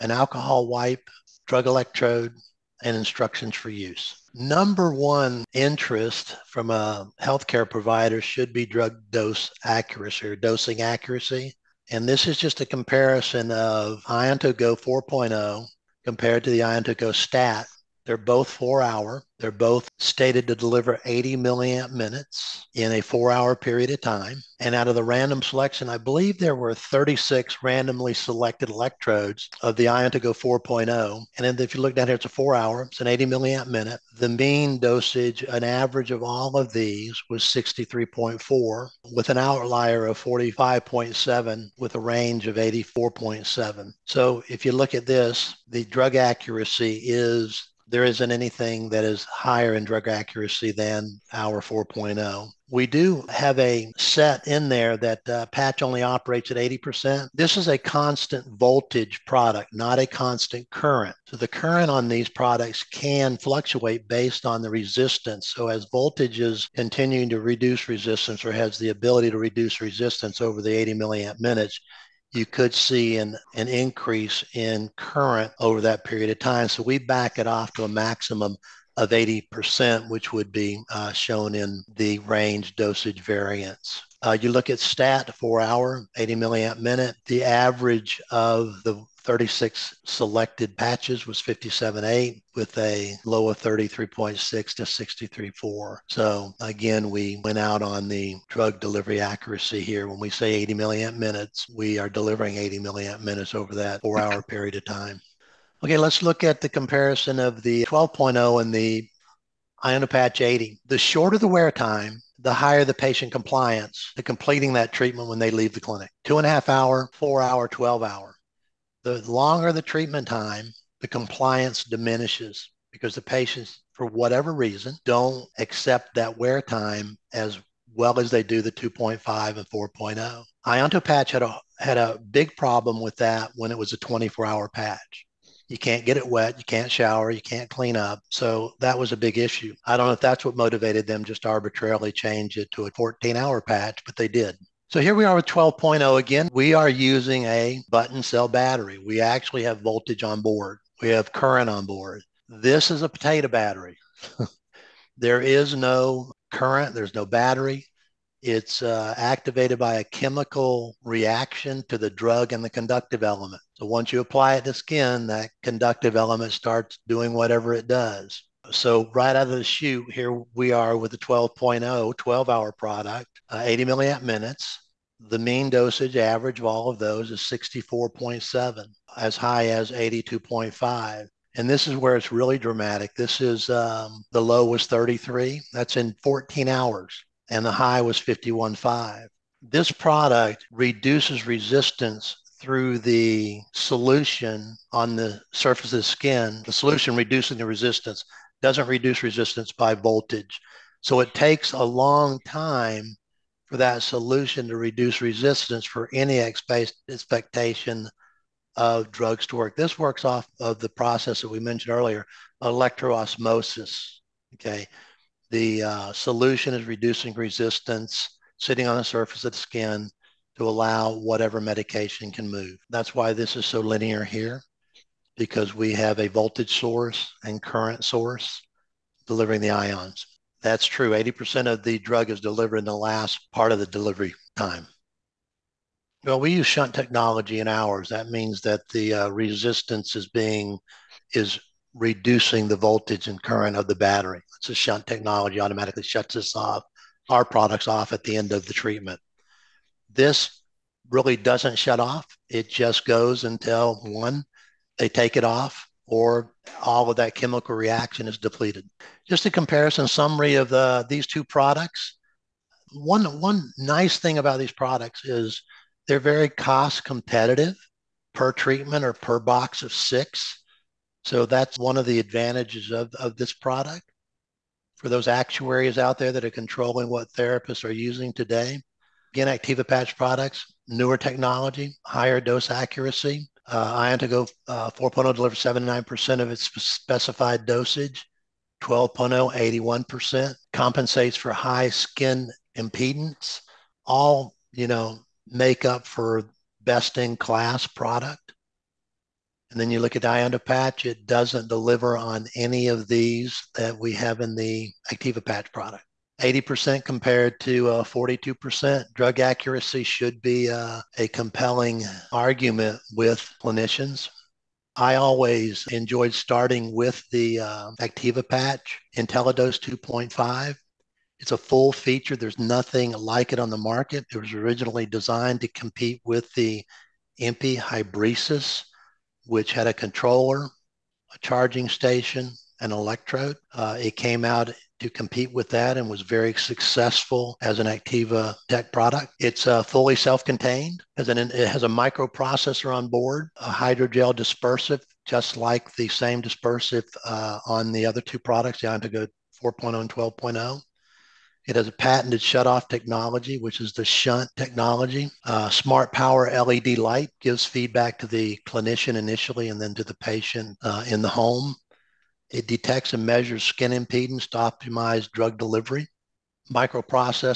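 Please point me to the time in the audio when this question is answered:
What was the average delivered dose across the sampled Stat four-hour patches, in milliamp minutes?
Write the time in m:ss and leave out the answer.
1:31.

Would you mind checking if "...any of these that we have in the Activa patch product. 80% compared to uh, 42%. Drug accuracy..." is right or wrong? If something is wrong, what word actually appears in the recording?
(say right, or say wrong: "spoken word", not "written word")
right.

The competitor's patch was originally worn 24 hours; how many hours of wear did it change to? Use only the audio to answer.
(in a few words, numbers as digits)
14.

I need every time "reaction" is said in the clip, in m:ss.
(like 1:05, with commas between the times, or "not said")
2:41, 4:17.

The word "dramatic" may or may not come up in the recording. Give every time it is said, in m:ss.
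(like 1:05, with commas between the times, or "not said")
3:02.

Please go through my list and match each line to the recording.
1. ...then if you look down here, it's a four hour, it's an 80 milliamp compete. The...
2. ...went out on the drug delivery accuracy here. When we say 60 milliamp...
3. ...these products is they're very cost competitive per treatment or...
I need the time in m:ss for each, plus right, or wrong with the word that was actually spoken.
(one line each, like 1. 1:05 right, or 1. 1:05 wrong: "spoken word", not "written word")
1. 0:31 wrong: "minute", not "compete"
2. 1:37 wrong: "80", not "60"
3. 4:24 right.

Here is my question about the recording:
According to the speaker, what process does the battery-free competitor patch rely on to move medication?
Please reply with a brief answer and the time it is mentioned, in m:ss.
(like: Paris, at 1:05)
electroosmosis, at 3:32.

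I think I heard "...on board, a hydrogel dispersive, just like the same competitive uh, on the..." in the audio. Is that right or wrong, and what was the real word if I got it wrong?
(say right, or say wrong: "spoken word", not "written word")
wrong: "dispersive", not "competitive".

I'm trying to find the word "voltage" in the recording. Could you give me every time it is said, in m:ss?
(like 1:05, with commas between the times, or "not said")
0:58, 1:05, 2:29, 3:19, 3:46, 4:02.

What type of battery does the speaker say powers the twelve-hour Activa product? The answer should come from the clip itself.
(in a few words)
button cell battery.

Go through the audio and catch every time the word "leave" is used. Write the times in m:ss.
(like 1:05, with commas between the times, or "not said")
1:55.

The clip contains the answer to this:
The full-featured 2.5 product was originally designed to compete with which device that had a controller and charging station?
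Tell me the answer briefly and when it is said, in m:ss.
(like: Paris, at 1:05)
MP Hybresis, at 5:27.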